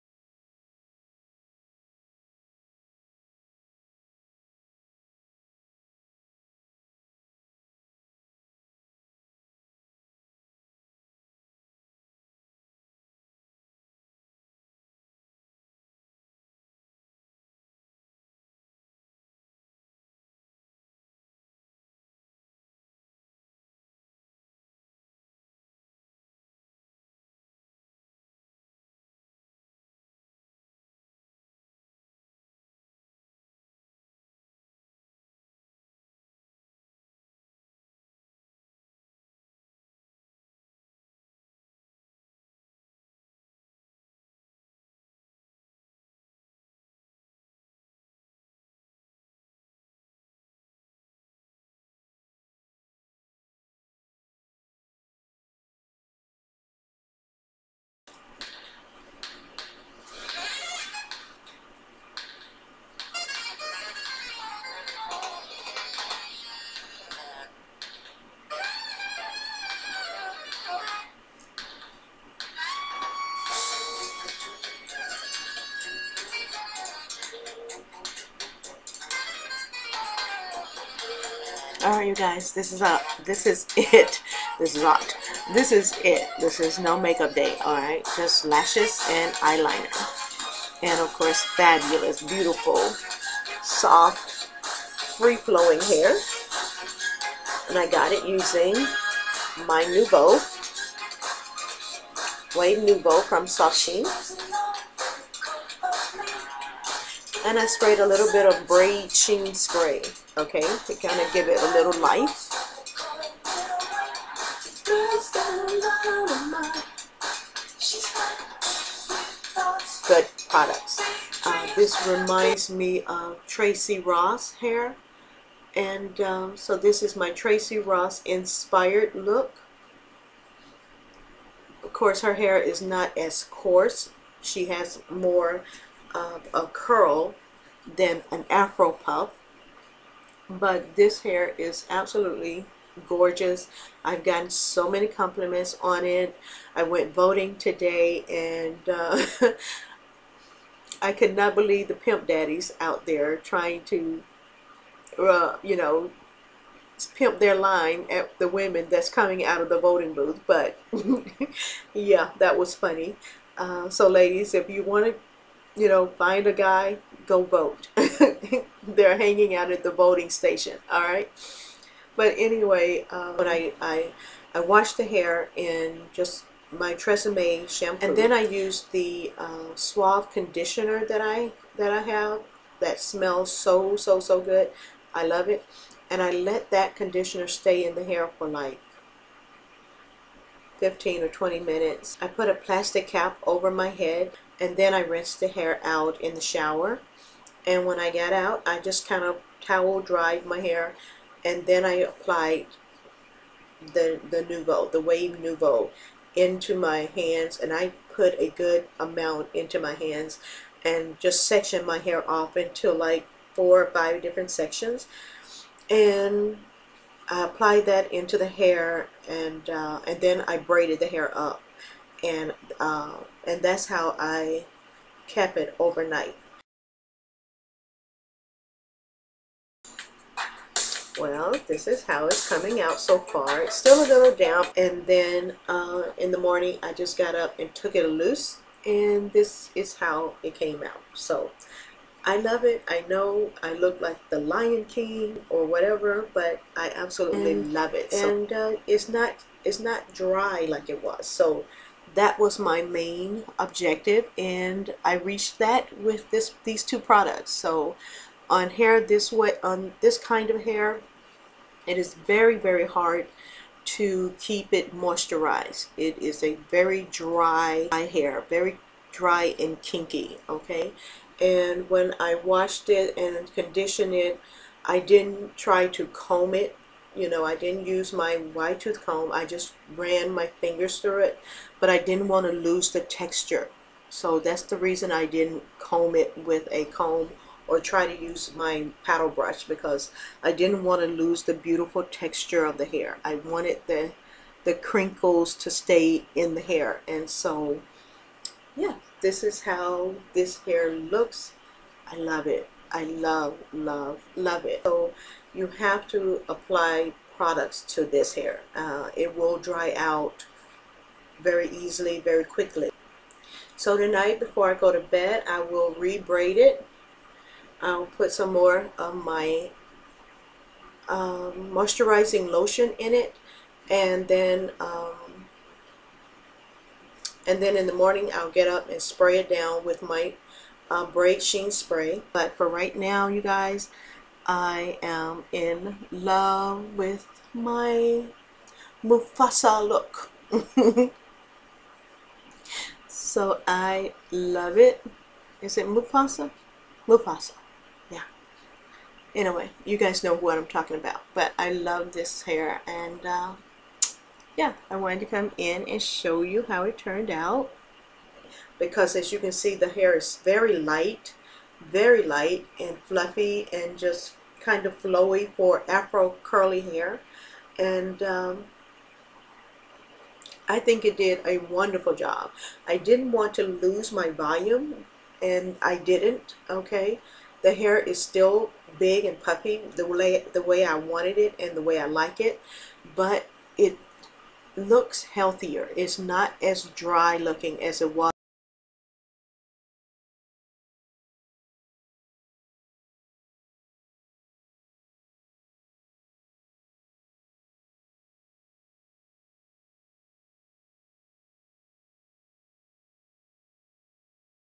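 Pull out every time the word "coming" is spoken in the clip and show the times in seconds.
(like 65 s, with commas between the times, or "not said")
159 s, 232 s.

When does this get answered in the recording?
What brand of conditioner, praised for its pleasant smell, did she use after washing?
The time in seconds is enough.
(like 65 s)
179 s.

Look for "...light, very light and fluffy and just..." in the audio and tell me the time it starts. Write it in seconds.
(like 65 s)
360 s.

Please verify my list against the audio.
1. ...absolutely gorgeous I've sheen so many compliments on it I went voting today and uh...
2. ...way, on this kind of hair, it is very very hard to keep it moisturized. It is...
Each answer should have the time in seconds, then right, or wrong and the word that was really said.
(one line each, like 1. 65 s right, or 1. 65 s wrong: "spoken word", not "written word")
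1. 141 s wrong: "gotten", not "sheen"
2. 259 s right.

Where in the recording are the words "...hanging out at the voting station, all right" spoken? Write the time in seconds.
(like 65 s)
169 s.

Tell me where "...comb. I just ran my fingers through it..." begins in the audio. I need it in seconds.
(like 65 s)
279 s.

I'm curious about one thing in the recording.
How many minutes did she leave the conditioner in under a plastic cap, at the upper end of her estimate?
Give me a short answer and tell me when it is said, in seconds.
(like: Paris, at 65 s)
20, at 191 s.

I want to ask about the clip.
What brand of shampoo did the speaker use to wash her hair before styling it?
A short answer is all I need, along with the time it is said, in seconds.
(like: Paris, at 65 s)
Tresemme, at 176 s.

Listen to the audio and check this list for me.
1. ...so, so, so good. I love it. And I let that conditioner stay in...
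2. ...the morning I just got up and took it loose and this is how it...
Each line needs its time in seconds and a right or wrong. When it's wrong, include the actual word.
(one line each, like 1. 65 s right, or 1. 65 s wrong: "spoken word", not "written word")
1. 183 s right
2. 236 s right.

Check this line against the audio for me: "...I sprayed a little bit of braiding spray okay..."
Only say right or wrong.
right.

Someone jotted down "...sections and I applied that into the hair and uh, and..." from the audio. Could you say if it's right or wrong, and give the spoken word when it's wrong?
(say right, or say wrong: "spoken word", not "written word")
right.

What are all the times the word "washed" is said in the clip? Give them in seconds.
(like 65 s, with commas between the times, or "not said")
174 s, 272 s.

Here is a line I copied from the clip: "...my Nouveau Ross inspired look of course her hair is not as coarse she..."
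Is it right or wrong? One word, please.
wrong.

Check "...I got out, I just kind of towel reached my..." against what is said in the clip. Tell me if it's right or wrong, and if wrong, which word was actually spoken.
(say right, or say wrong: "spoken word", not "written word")
wrong: "dried", not "reached".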